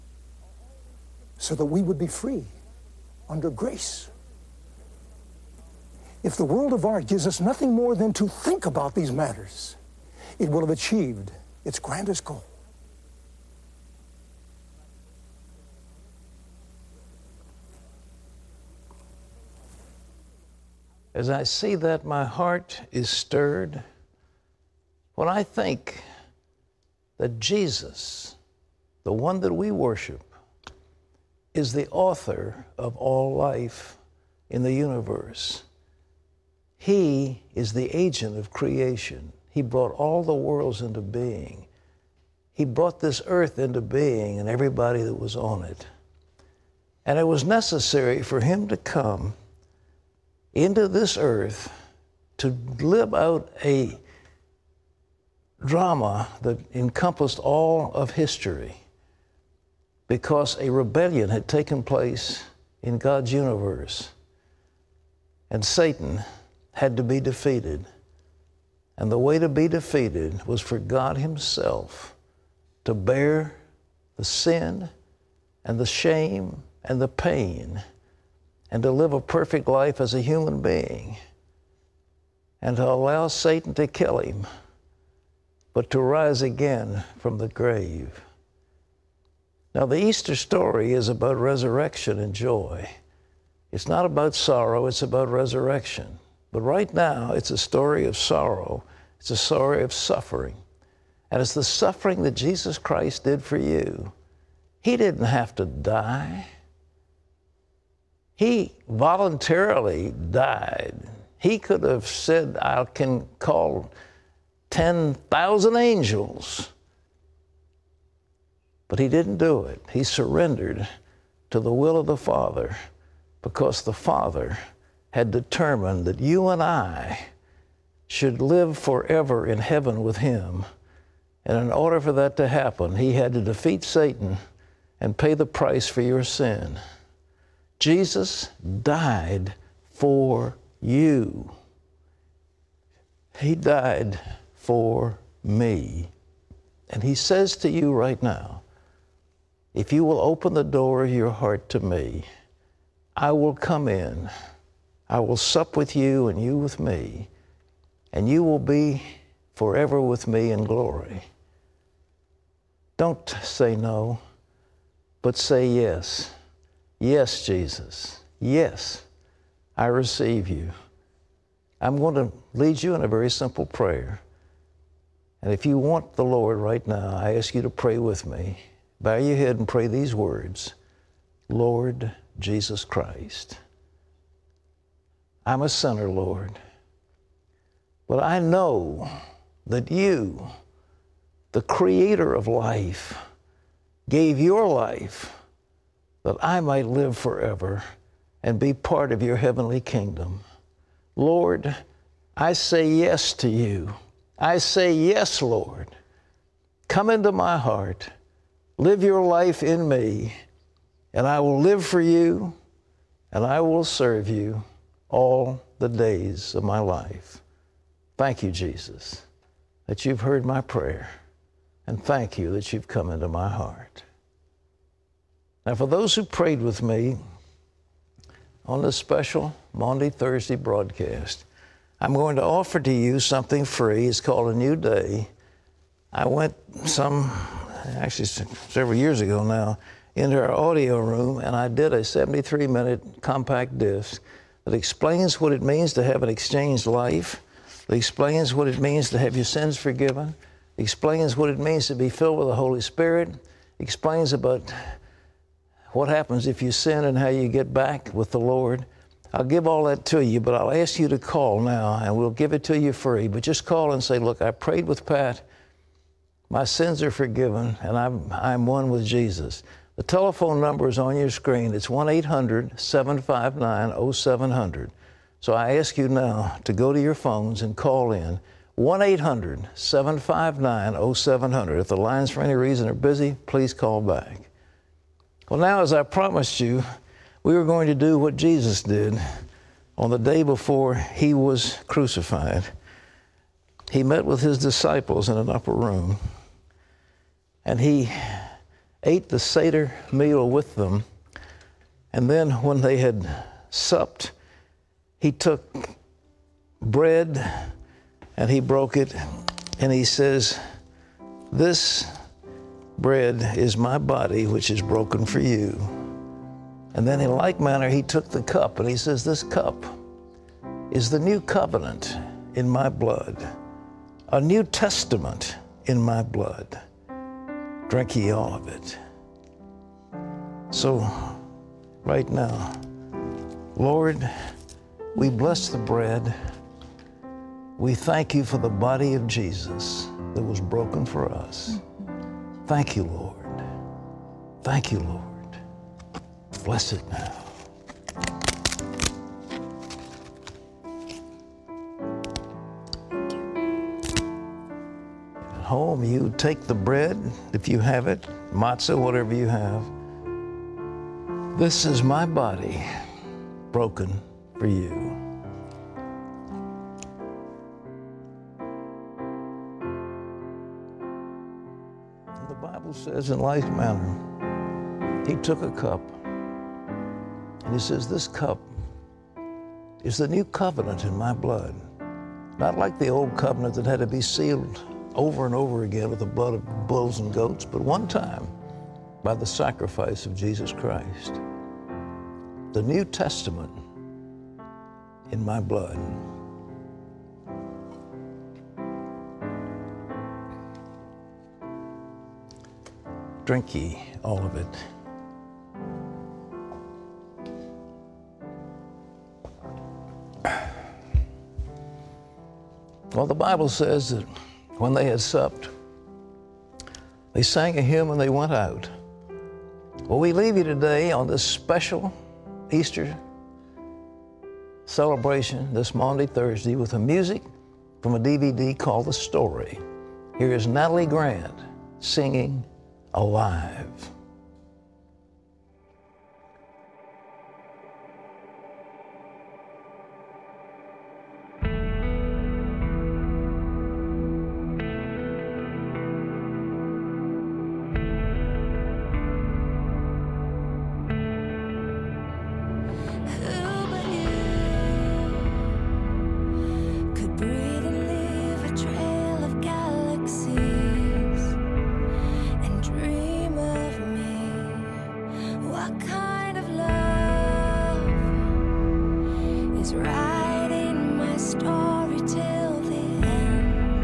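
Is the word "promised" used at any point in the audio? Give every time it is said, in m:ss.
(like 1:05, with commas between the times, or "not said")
4:46.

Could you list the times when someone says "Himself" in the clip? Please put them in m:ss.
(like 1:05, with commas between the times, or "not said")
1:11.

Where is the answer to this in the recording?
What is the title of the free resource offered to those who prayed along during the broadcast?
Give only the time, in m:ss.
3:54.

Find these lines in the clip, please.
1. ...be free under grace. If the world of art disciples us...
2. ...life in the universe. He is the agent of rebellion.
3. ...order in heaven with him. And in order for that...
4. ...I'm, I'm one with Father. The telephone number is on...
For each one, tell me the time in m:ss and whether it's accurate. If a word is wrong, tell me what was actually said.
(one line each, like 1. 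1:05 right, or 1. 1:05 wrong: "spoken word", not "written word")
1. 0:01 wrong: "gives", not "disciples"
2. 0:33 wrong: "creation", not "rebellion"
3. 2:08 wrong: "forever", not "order"
4. 4:27 wrong: "Jesus", not "Father".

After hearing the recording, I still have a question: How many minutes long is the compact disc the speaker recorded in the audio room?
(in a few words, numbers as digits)
73.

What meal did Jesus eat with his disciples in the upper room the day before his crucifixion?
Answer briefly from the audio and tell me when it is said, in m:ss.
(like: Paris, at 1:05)
Seder meal, at 4:59.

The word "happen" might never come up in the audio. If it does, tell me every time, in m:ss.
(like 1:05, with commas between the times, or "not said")
2:12, 4:16.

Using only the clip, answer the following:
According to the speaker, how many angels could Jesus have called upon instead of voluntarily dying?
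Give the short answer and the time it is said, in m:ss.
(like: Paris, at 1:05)
10,000, at 1:54.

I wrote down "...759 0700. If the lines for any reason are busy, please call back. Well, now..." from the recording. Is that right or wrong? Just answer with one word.
right.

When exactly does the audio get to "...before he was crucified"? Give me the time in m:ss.
4:50.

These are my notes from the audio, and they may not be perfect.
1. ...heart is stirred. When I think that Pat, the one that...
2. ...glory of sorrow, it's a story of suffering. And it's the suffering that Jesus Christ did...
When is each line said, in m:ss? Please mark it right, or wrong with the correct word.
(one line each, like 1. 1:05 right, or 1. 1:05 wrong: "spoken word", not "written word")
1. 0:22 wrong: "Jesus", not "Pat"
2. 1:37 wrong: "story", not "glory".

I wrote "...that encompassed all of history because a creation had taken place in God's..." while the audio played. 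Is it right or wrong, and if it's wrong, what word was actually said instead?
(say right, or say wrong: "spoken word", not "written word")
wrong: "rebellion", not "creation".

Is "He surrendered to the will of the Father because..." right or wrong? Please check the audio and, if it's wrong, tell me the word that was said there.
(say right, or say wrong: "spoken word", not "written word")
right.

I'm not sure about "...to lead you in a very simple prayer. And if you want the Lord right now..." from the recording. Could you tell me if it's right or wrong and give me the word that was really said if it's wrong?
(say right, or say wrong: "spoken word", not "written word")
right.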